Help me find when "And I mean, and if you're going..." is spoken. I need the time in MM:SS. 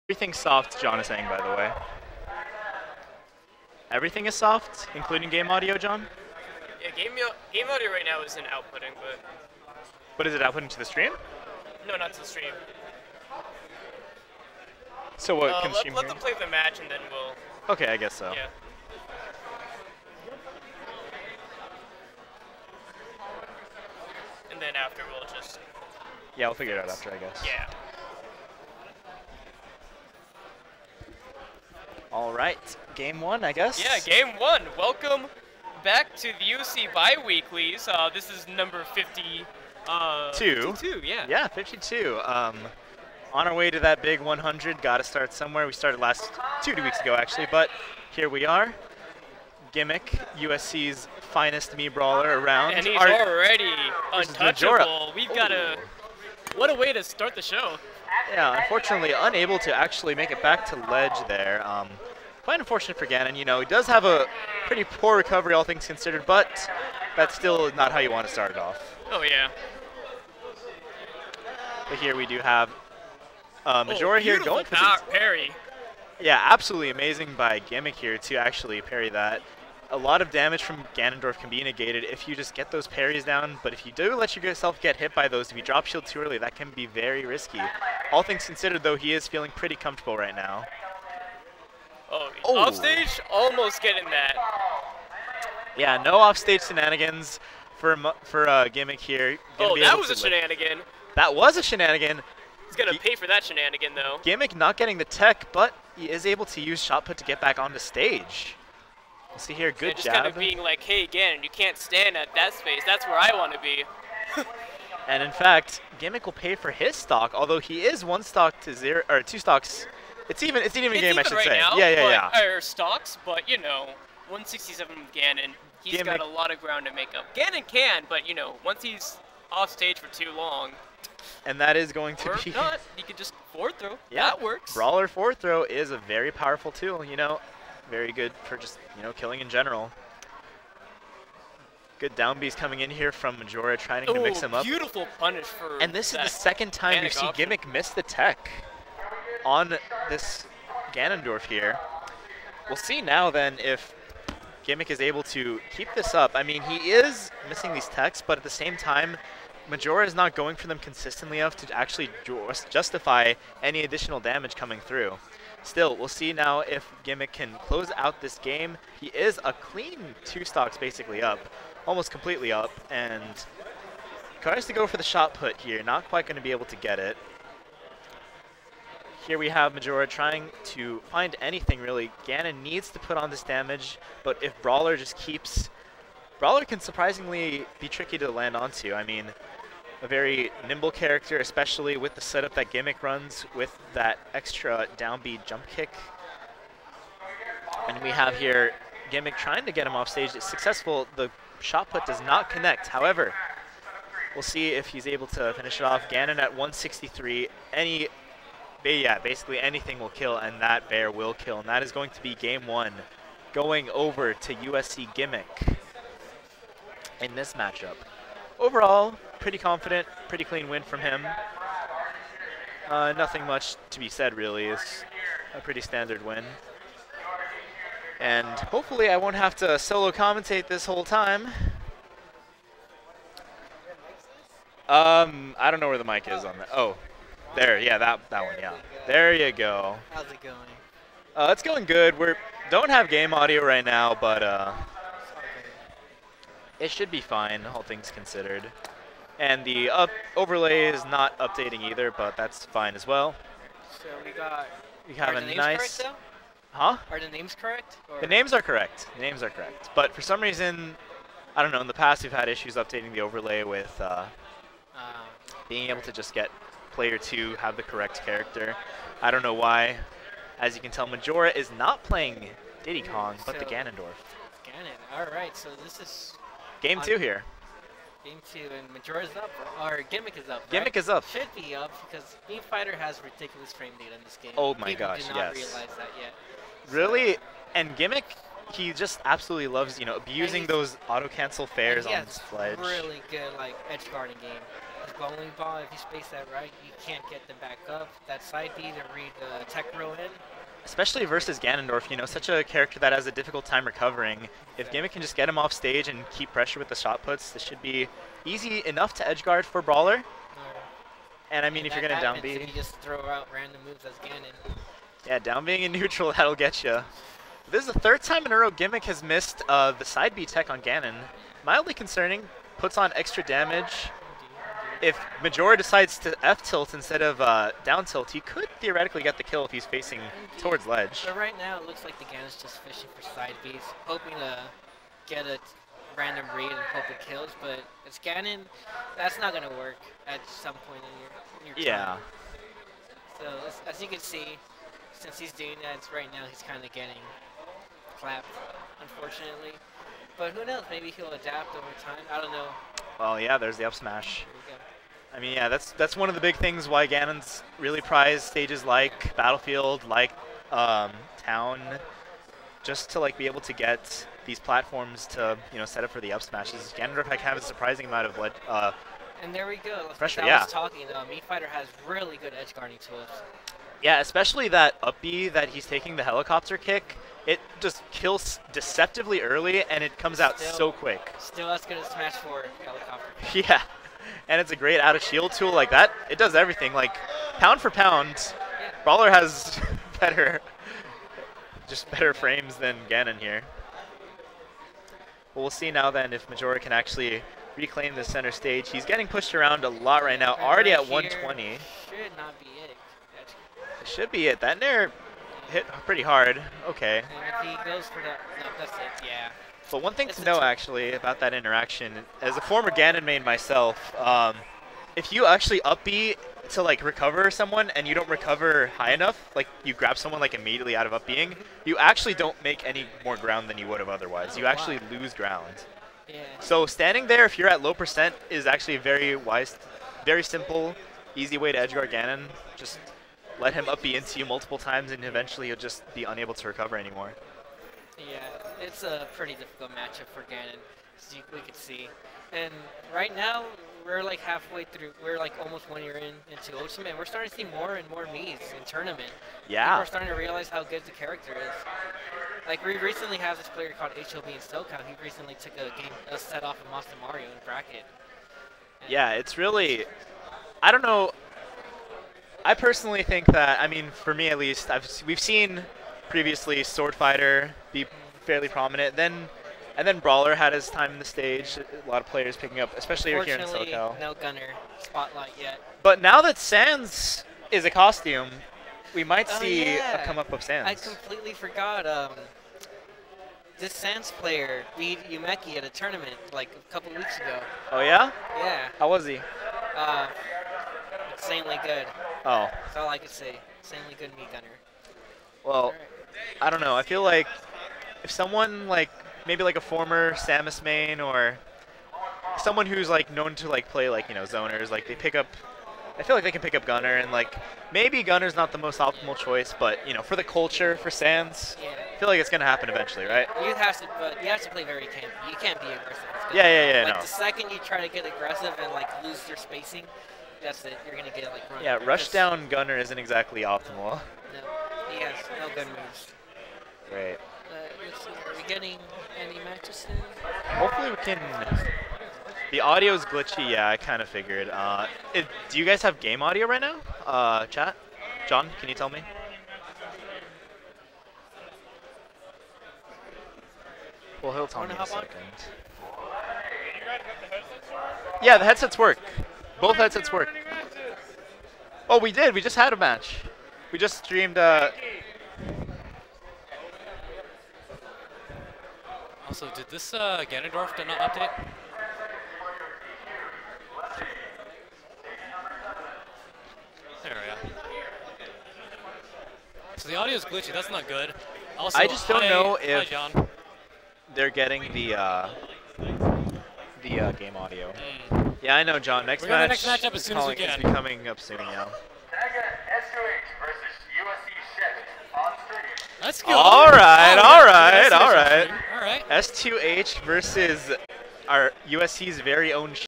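05:11.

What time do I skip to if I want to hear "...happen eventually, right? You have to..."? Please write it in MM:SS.
08:32.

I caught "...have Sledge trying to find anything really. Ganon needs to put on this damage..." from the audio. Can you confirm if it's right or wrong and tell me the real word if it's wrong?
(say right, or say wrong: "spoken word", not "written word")
wrong: "Majora", not "Sledge".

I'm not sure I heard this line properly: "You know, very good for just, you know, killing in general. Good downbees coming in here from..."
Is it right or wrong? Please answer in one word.
right.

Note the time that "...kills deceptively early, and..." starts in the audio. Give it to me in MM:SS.
06:18.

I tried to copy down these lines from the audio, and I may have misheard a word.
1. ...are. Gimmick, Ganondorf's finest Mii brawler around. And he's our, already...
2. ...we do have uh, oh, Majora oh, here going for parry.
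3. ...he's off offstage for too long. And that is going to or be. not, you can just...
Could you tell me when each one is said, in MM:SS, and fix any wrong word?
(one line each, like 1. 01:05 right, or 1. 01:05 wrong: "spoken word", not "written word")
1. 00:48 wrong: "USC", not "Ganondorf"
2. 01:12 right
3. 02:08 wrong: "stage", not "offstage".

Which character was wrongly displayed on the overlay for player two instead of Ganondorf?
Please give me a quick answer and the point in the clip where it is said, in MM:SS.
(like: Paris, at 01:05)
Diddy Kong, at 04:32.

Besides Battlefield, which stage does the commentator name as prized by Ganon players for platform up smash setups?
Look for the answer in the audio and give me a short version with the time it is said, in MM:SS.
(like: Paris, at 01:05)
Town, at 06:01.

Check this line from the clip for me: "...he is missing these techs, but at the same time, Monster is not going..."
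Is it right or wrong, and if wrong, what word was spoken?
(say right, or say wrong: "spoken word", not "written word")
wrong: "Majora", not "Monster".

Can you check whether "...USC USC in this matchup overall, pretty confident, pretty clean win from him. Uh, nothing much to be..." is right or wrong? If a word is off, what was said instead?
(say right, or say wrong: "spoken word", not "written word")
wrong: "Gimmick", not "USC".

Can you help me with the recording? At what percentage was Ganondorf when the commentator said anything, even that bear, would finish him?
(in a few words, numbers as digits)
163.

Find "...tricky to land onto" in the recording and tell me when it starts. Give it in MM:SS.
03:07.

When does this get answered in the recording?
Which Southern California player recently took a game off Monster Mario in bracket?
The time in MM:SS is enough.
07:34.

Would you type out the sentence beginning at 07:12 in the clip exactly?
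Just let him up be into you multiple times, and eventually you'll just be unable to recover anymore.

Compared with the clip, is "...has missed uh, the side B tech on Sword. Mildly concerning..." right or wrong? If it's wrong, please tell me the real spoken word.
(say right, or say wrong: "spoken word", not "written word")
wrong: "Ganon", not "Sword".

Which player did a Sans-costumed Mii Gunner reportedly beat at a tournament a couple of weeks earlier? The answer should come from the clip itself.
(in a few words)
Yumeki.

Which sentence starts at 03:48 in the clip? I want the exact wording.
And hopefully I won't have to solo commentate this whole time.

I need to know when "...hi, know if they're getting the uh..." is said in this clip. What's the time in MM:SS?
09:32.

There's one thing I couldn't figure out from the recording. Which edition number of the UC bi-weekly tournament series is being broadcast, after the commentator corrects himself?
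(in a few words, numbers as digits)
52.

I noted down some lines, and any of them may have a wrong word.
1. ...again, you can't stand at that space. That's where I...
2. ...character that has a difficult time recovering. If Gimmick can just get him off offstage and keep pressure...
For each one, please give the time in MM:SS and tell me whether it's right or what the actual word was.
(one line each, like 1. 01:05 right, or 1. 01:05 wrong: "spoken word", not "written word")
1. 01:51 right
2. 05:02 wrong: "stage", not "offstage".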